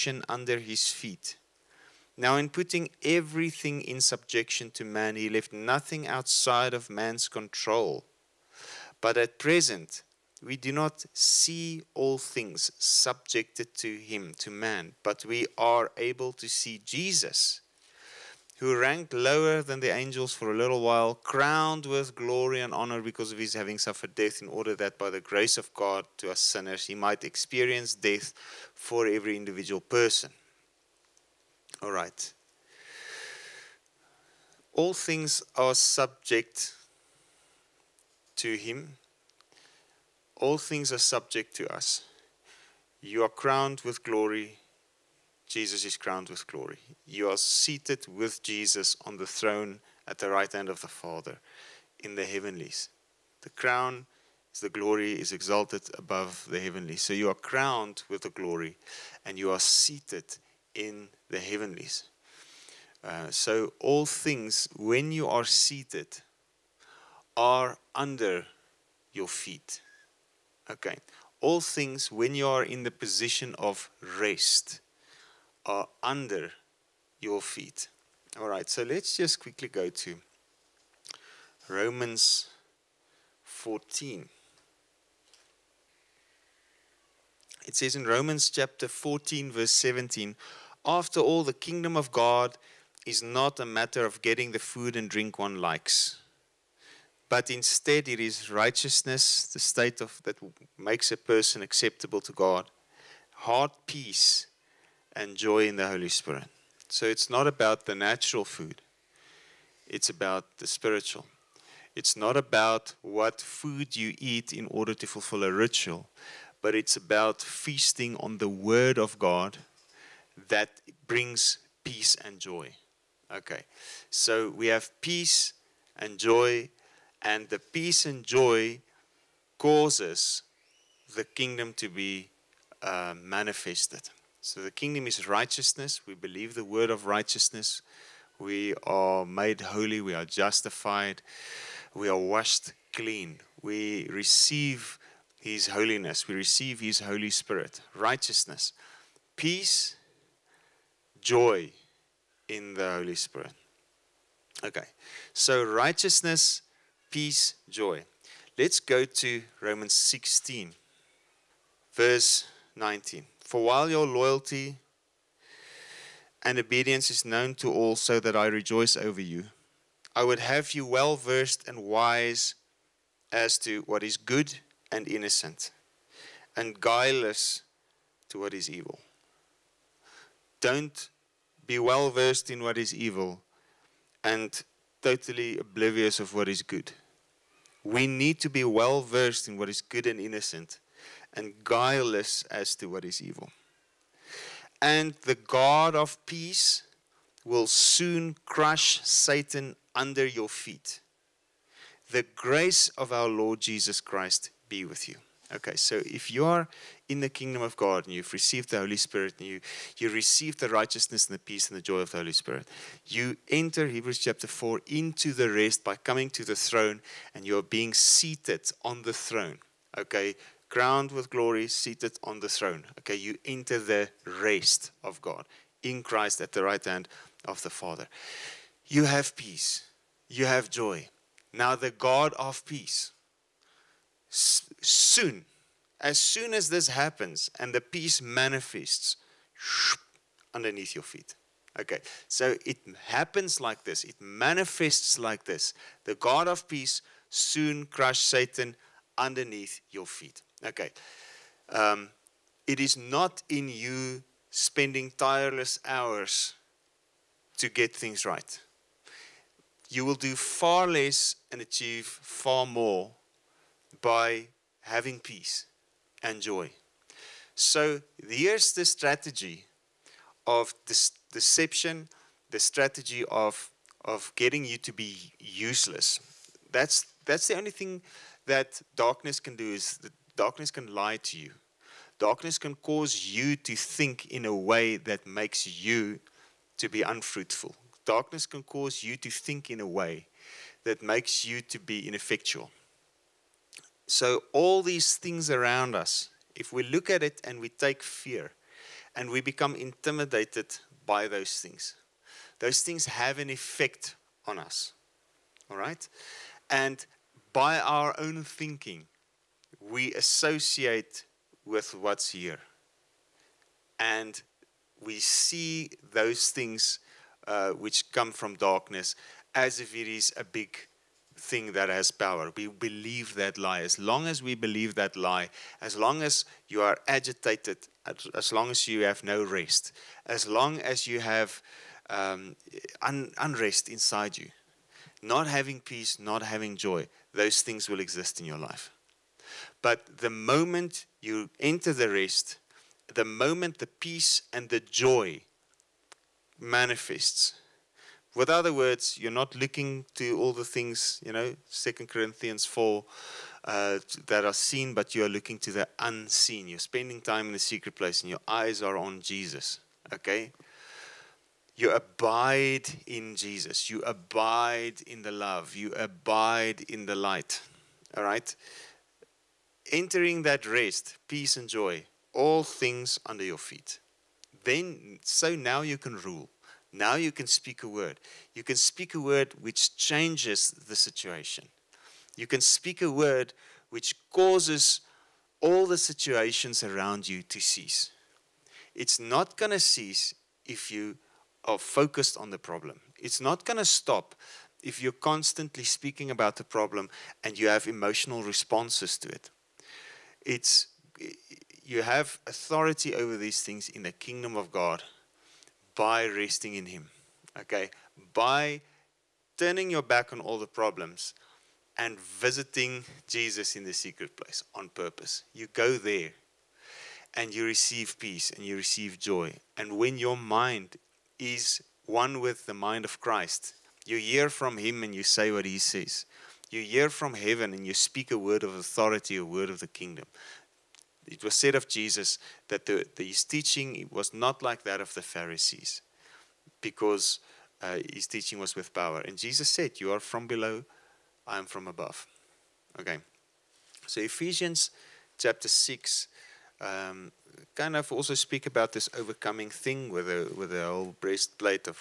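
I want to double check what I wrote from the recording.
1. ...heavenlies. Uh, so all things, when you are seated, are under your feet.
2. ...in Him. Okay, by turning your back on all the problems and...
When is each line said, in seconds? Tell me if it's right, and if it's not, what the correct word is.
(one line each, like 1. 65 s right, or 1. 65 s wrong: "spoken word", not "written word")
1. 61 s right
2. 406 s right.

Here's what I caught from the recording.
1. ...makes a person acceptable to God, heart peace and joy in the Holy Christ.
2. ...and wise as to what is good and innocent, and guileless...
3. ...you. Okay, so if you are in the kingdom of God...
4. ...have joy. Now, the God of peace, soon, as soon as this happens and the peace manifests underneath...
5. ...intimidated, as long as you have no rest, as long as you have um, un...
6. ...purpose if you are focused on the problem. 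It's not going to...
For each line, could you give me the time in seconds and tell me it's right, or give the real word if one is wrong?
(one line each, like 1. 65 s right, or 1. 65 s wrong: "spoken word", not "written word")
1. 100 s wrong: "Spirit", not "Christ"
2. 171 s right
3. 205 s right
4. 230 s right
5. 327 s wrong: "agitated", not "intimidated"
6. 389 s wrong: "cease", not "purpose".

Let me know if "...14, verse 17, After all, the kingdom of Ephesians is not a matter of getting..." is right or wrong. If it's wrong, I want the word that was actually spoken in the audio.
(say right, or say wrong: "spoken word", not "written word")
wrong: "God", not "Ephesians".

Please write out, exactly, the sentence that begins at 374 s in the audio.
Then, so now you can rule.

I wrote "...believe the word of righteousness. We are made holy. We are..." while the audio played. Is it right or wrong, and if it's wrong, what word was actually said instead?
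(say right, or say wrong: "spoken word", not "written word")
right.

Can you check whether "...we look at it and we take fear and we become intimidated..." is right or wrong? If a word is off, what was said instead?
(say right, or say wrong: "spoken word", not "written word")
right.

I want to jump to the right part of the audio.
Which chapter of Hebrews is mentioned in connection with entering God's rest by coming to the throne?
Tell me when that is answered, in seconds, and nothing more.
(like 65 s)
213 s.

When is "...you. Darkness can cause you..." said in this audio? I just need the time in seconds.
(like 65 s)
281 s.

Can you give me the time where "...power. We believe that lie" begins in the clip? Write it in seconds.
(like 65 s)
322 s.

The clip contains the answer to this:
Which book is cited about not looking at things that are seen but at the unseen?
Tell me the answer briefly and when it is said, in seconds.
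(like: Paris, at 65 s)
Second Corinthians 4, at 351 s.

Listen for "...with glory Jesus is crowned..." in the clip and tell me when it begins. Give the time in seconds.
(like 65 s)
43 s.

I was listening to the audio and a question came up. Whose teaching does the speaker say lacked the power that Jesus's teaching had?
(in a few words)
The Pharisees.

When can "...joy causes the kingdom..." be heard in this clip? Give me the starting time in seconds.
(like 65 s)
128 s.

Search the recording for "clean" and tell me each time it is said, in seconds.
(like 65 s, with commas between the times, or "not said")
142 s.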